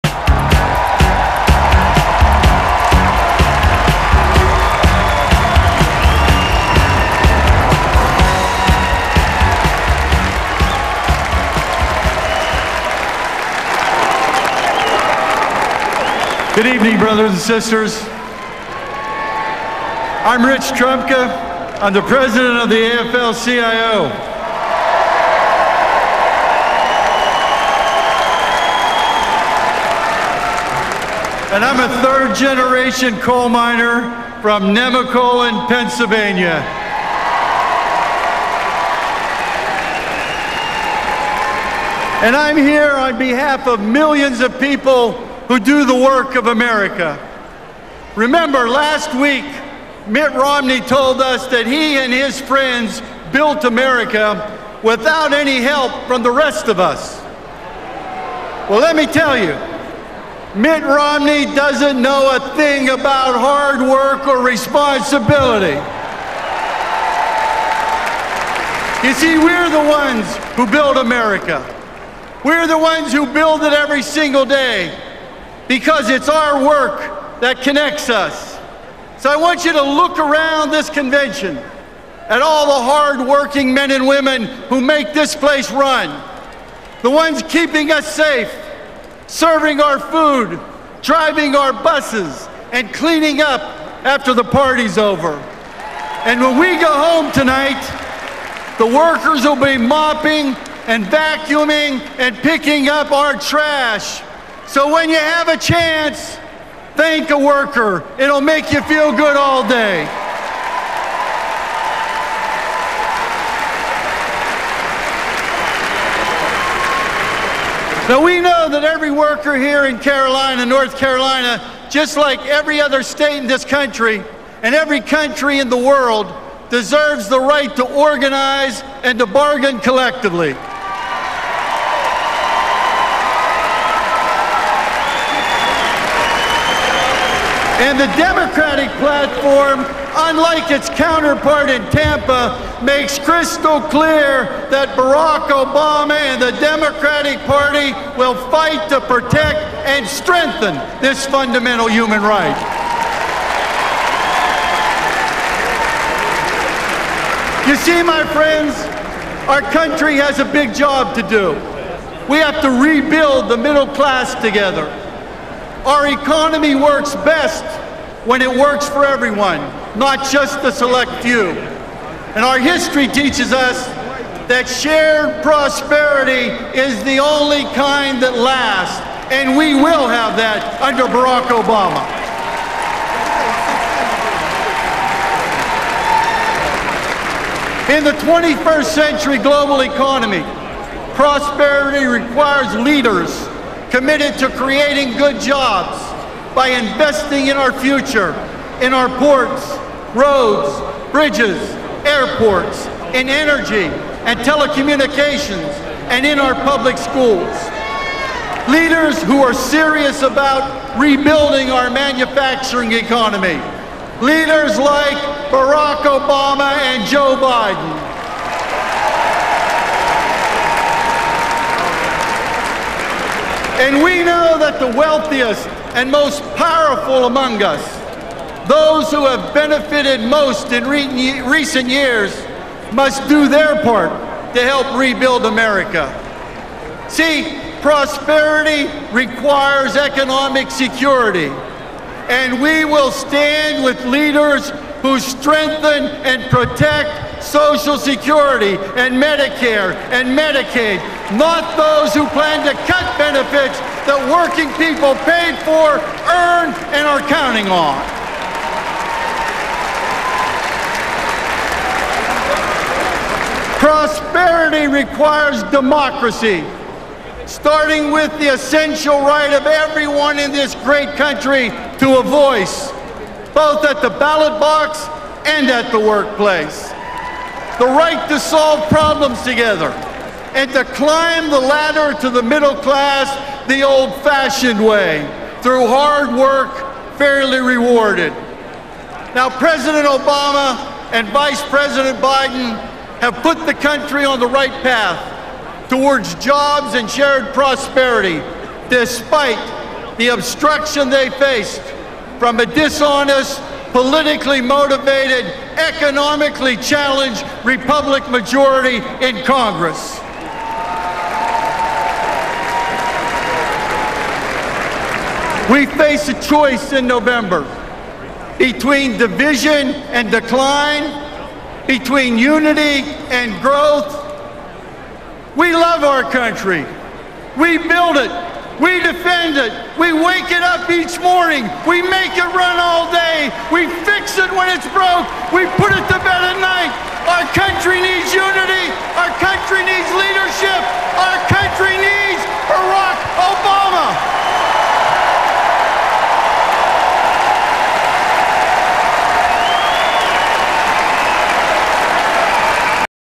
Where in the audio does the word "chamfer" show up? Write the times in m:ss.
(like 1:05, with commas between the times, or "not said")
not said.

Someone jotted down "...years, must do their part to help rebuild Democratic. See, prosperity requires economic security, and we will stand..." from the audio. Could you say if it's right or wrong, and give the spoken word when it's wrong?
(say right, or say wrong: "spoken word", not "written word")
wrong: "America", not "Democratic".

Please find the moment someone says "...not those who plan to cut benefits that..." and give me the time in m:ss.
4:11.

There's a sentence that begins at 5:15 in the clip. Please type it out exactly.
We face a choice in November between division and decline, between unity and growth.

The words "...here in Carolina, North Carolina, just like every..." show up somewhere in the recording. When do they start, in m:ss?
1:59.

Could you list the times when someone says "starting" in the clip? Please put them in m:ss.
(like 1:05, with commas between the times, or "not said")
4:27.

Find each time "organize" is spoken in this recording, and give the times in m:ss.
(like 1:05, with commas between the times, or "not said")
2:07.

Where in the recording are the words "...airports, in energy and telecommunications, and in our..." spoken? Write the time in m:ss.
3:22.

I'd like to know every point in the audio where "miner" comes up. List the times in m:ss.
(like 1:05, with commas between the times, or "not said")
0:33.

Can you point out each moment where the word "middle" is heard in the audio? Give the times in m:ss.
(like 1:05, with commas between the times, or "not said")
2:43, 4:42.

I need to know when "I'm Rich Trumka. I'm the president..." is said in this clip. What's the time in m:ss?
0:20.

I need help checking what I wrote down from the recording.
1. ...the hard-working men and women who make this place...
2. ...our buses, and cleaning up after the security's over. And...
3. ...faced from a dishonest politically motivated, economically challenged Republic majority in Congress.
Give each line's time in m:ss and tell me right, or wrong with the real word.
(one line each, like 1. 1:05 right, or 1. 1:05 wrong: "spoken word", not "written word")
1. 1:22 right
2. 1:31 wrong: "party", not "security"
3. 5:01 right.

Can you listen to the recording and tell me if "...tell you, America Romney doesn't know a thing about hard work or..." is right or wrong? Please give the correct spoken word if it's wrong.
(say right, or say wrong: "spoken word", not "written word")
wrong: "Mitt", not "America".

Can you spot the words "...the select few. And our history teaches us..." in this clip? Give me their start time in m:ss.
2:50.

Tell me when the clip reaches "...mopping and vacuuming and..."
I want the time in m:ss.
1:39.